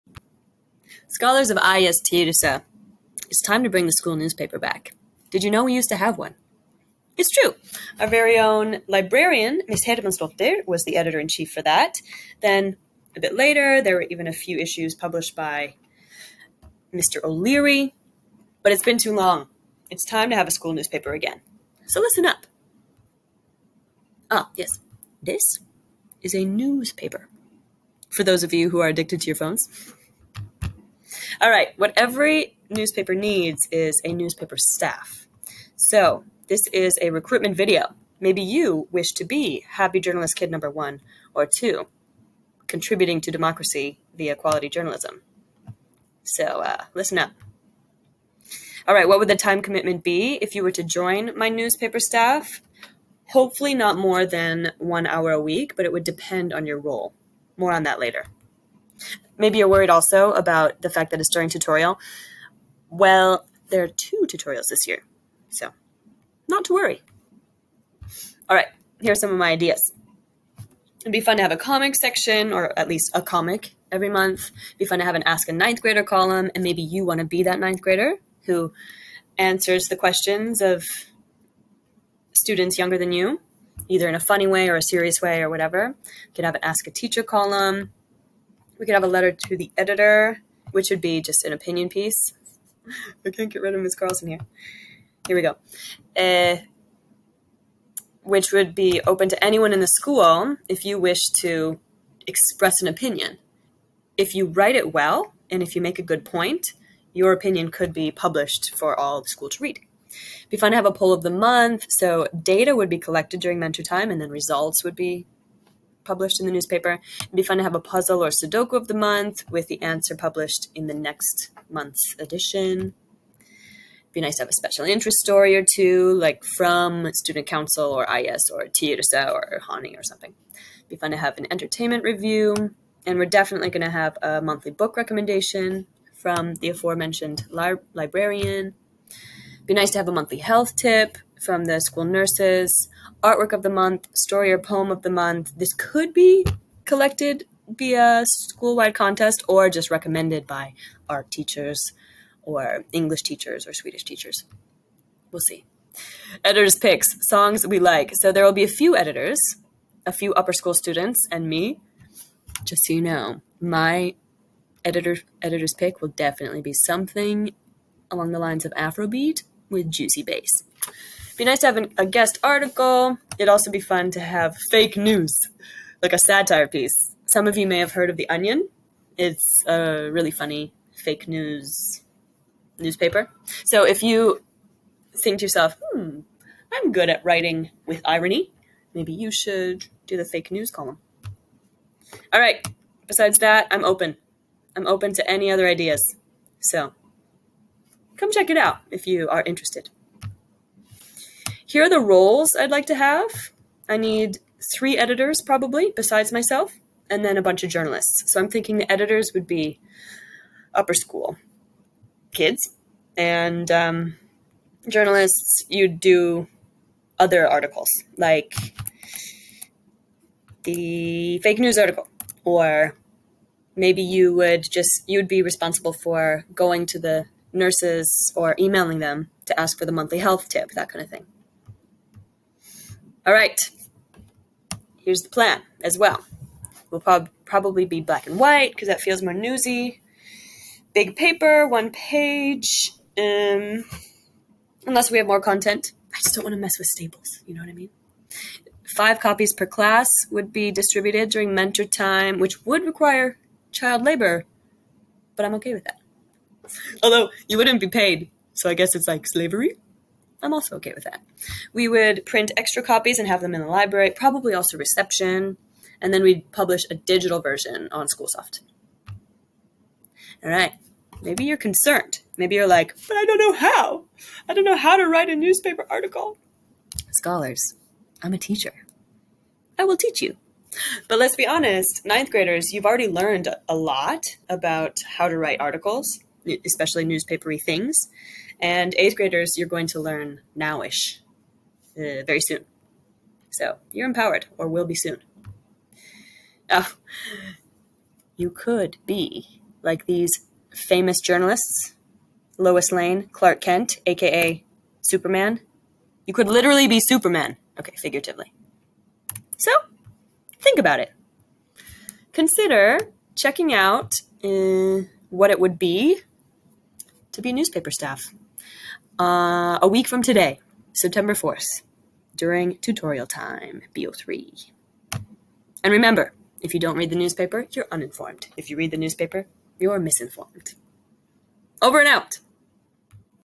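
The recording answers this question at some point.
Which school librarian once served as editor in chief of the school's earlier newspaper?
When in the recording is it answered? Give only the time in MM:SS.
00:09.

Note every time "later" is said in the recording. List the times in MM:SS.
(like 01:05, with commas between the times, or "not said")
00:13, 00:57.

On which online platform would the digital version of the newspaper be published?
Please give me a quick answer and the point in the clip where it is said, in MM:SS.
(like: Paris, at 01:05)
Schoolsoft, at 04:28.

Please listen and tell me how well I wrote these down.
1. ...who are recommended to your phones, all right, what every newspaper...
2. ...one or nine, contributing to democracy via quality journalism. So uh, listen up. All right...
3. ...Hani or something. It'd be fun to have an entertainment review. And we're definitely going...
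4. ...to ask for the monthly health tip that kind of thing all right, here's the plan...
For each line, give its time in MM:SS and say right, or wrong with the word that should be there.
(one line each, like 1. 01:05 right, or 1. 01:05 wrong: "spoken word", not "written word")
1. 00:28 wrong: "addicted", not "recommended"
2. 00:40 wrong: "two", not "nine"
3. 02:09 right
4. 03:49 right.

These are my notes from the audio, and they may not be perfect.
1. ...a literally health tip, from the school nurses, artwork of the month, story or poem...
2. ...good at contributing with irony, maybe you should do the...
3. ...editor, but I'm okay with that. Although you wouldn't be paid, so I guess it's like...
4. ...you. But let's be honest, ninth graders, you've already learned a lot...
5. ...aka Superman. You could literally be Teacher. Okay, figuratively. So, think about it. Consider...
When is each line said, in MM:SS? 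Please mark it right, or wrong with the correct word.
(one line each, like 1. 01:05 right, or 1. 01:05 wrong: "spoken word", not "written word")
1. 02:20 wrong: "monthly", not "literally"
2. 03:06 wrong: "writing", not "contributing"
3. 04:14 wrong: "labor", not "editor"
4. 04:40 right
5. 05:04 wrong: "Superman", not "Teacher".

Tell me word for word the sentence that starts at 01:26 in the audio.
You could have an Ask a Teacher column.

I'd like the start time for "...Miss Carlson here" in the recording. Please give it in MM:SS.
01:33.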